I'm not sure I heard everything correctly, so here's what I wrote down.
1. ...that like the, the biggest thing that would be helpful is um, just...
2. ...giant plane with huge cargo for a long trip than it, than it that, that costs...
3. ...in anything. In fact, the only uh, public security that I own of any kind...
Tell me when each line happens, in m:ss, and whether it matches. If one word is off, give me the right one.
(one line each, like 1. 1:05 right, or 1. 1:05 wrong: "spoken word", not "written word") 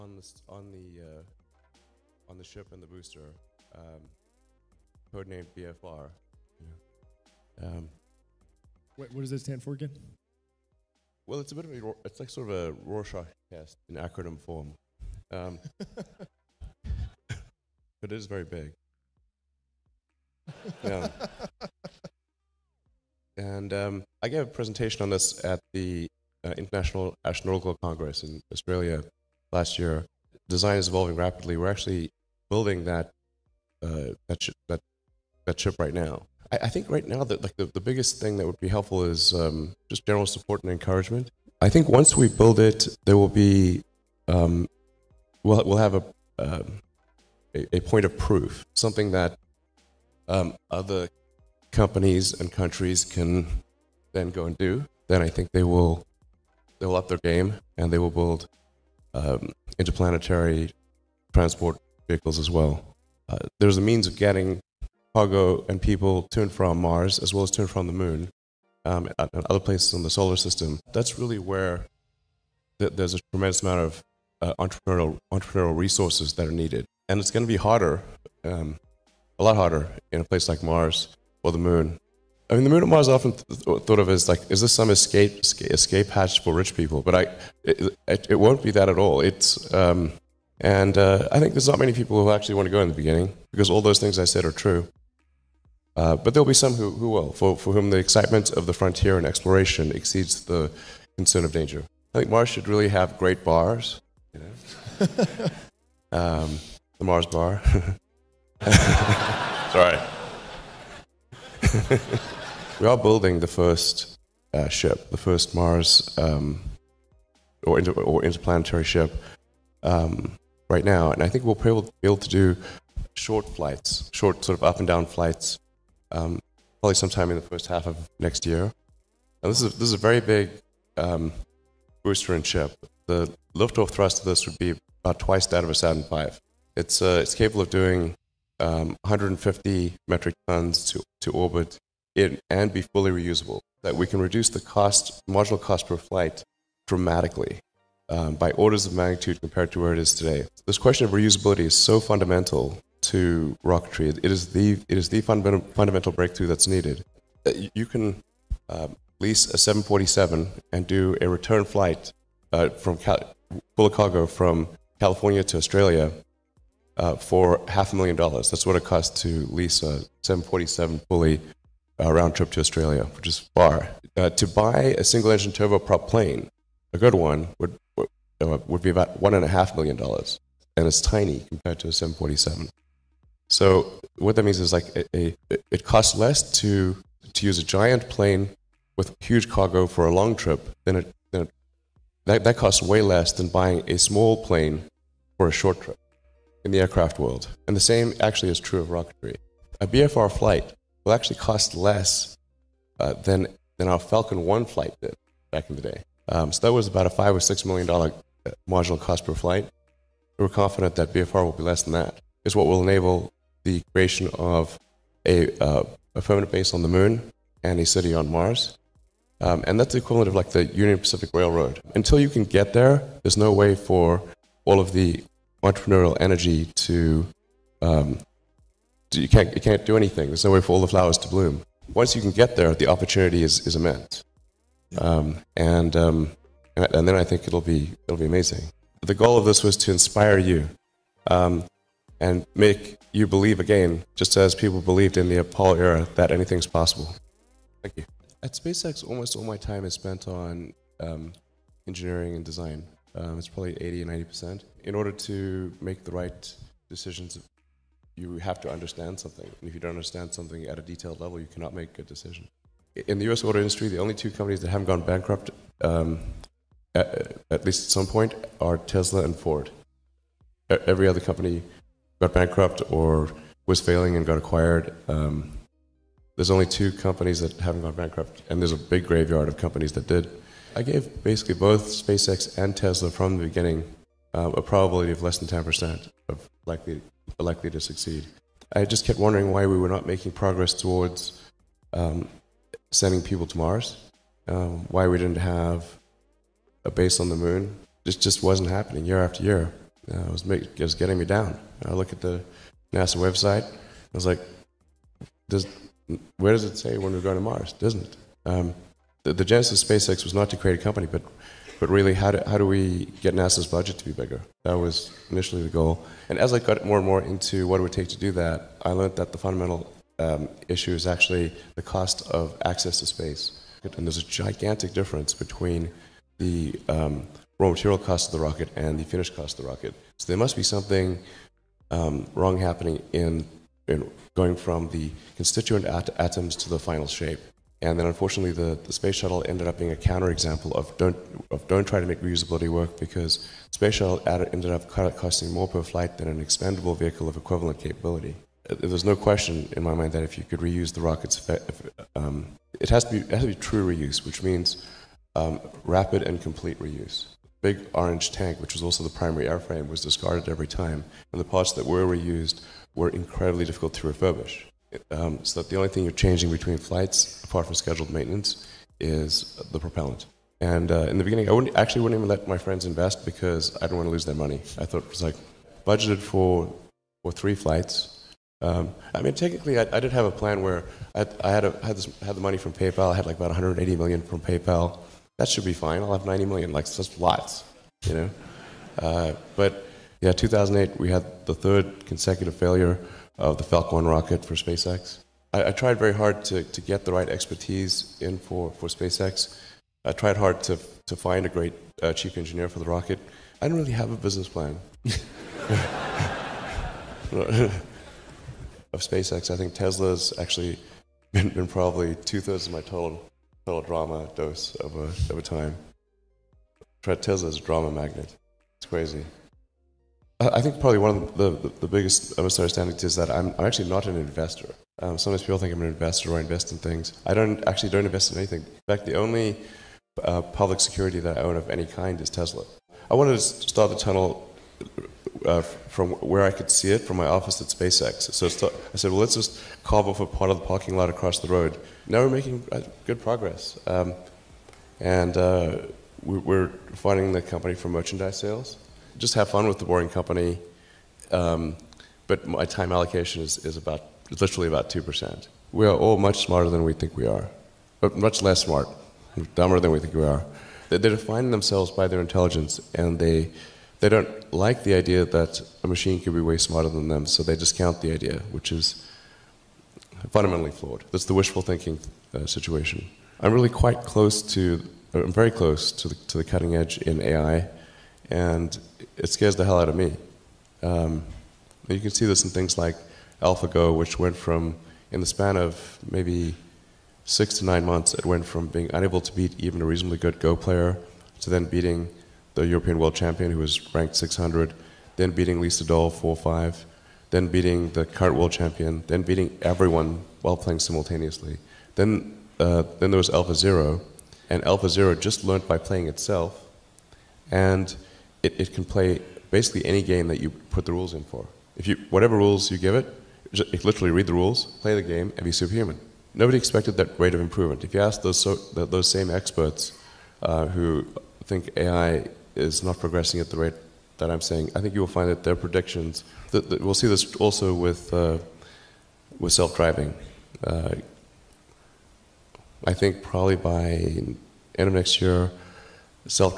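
1. 0:37 right
2. 3:07 right
3. 7:08 right.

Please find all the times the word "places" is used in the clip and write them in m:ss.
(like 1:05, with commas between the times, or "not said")
1:09, 1:20.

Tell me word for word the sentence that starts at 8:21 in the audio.
Then, uh, then there was AlphaZero, and AlphaZero just learned by playing itself.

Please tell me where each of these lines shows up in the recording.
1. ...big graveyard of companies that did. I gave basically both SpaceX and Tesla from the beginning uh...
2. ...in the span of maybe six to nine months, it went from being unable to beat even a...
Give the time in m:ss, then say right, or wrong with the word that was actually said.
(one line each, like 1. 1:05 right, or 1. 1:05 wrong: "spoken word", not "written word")
1. 4:38 right
2. 8:05 right.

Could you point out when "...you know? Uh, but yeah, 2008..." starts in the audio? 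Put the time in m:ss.
6:28.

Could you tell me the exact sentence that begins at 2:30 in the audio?
This question of reusability is so fundamental to rocketry.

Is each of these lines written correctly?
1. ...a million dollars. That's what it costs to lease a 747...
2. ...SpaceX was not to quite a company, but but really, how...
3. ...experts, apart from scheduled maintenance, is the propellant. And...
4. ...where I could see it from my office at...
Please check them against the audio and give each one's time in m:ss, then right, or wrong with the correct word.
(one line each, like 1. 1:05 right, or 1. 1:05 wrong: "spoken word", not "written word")
1. 2:47 right
2. 5:09 wrong: "create", not "quite"
3. 6:06 wrong: "flights", not "experts"
4. 7:16 right.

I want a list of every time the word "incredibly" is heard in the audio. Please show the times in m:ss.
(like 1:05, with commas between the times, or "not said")
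6:03.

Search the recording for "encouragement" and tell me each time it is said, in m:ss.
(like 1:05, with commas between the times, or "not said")
0:40.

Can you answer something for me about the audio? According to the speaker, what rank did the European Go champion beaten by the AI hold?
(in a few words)
600.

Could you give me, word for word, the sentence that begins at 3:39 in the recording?
Um, and that's the equivalent of like the Union Pacific Railroad.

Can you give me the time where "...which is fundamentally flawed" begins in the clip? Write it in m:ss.
7:48.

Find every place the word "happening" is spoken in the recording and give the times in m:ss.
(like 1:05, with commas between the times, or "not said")
4:58, 5:32.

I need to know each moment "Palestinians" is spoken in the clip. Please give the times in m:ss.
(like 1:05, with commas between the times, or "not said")
not said.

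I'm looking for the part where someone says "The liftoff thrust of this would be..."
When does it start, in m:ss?
2:13.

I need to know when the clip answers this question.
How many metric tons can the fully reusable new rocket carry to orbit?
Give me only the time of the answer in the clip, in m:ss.
2:19.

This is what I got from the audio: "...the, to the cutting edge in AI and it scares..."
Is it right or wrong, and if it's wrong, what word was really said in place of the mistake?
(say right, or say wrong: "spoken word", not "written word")
right.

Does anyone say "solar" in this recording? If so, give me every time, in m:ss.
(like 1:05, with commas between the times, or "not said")
1:10.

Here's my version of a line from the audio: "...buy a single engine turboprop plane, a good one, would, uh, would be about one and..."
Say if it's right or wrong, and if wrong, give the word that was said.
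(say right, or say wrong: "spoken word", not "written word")
right.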